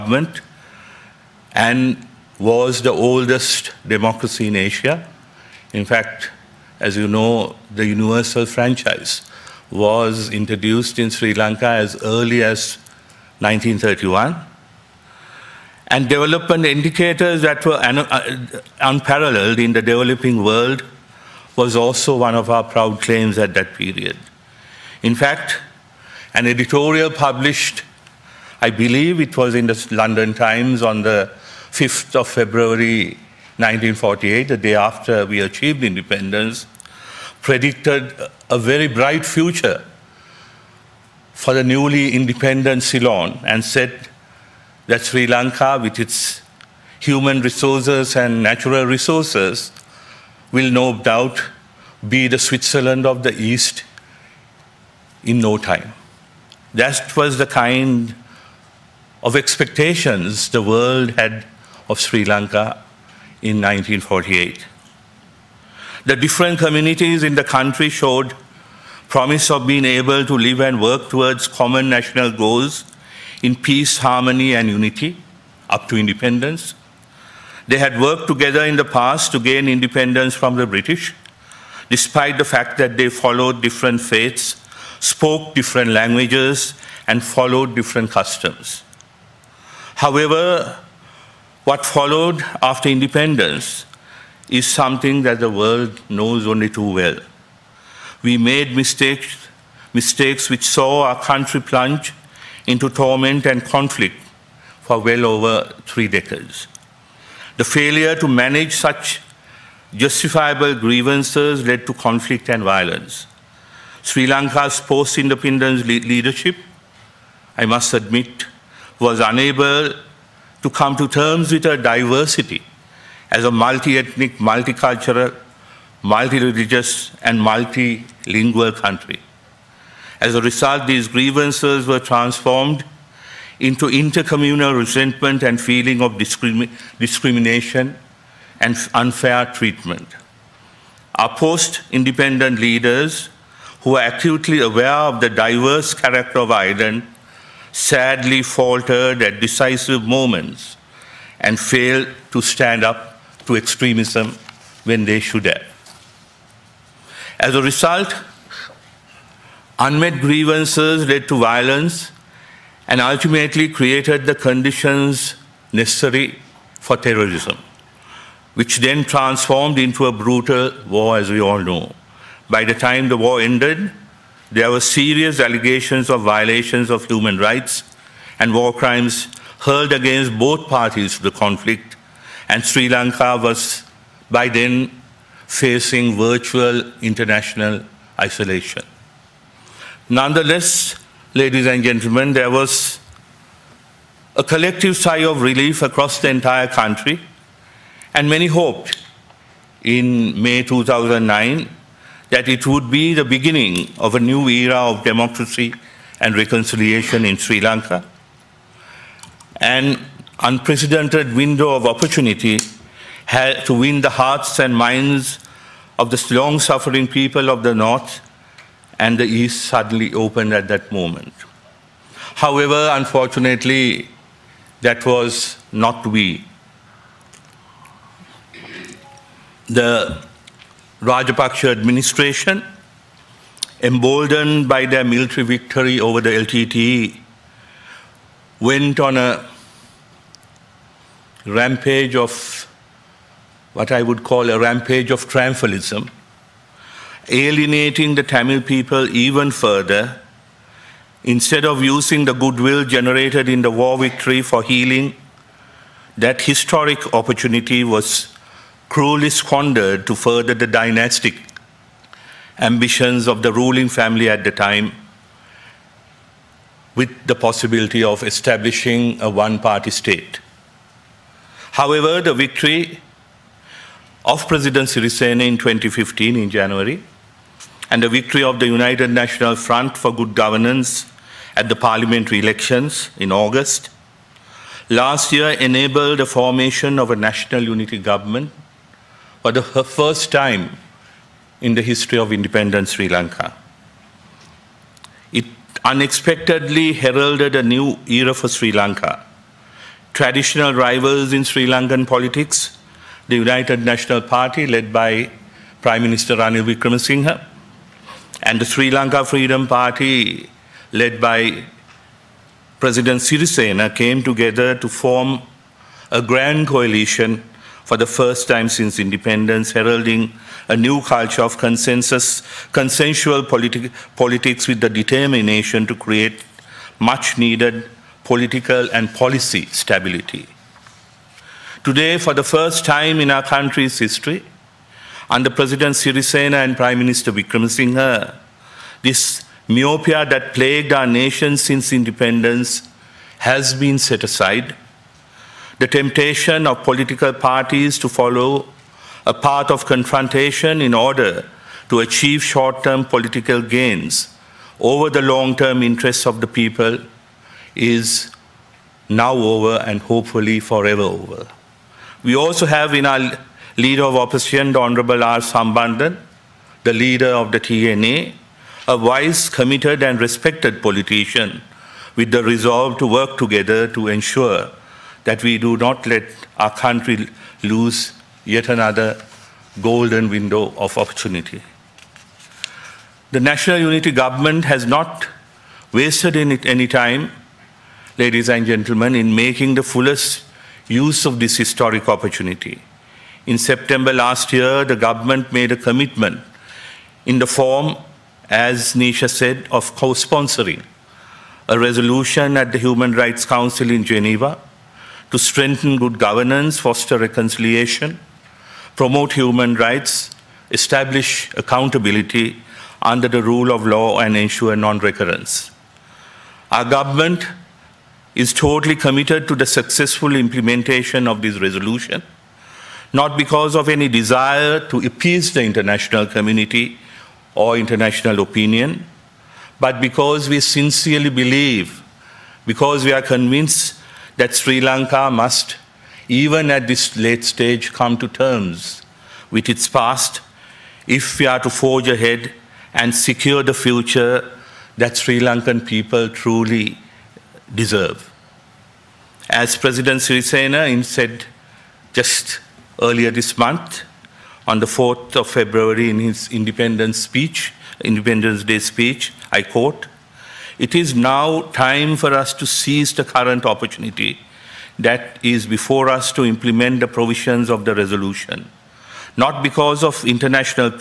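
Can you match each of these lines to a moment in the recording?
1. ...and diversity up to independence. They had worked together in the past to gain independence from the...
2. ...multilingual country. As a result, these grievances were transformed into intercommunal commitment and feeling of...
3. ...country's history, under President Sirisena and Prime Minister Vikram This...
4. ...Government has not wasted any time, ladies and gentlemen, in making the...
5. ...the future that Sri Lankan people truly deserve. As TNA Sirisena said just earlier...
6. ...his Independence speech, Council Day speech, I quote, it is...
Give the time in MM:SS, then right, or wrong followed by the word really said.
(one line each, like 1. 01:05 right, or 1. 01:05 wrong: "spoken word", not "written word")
1. 01:14 wrong: "unity", not "diversity"
2. 02:07 wrong: "resentment", not "commitment"
3. 05:33 right
4. 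06:24 right
5. 07:23 wrong: "President", not "TNA"
6. 07:36 wrong: "Independence", not "Council".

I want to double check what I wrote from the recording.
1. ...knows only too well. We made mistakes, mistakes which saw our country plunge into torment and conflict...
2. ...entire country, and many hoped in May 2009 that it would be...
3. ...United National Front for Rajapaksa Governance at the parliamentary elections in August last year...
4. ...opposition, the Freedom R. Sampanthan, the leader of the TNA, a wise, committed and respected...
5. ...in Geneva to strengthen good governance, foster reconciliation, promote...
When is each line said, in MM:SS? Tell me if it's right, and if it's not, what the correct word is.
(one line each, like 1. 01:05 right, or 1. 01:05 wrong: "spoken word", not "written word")
1. 01:36 right
2. 03:16 right
3. 04:38 wrong: "Good", not "Rajapaksa"
4. 06:04 wrong: "Honorable", not "Freedom"
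5. 06:43 right.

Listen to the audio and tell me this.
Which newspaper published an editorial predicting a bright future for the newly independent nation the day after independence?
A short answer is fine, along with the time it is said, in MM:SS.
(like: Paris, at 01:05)
London Times, at 00:29.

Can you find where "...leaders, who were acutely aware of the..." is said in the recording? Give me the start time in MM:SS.
02:22.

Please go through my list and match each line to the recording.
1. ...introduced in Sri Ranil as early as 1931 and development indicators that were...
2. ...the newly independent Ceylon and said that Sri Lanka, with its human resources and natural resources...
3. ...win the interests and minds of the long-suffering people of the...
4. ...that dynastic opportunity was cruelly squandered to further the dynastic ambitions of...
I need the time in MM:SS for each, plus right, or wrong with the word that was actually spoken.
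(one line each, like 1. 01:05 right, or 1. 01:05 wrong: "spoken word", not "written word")
1. 00:10 wrong: "Lanka", not "Ranil"
2. 00:41 right
3. 03:33 wrong: "hearts", not "interests"
4. 04:16 wrong: "historic", not "dynastic".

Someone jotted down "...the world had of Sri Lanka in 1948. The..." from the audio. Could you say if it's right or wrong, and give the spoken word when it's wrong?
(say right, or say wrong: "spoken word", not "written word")
right.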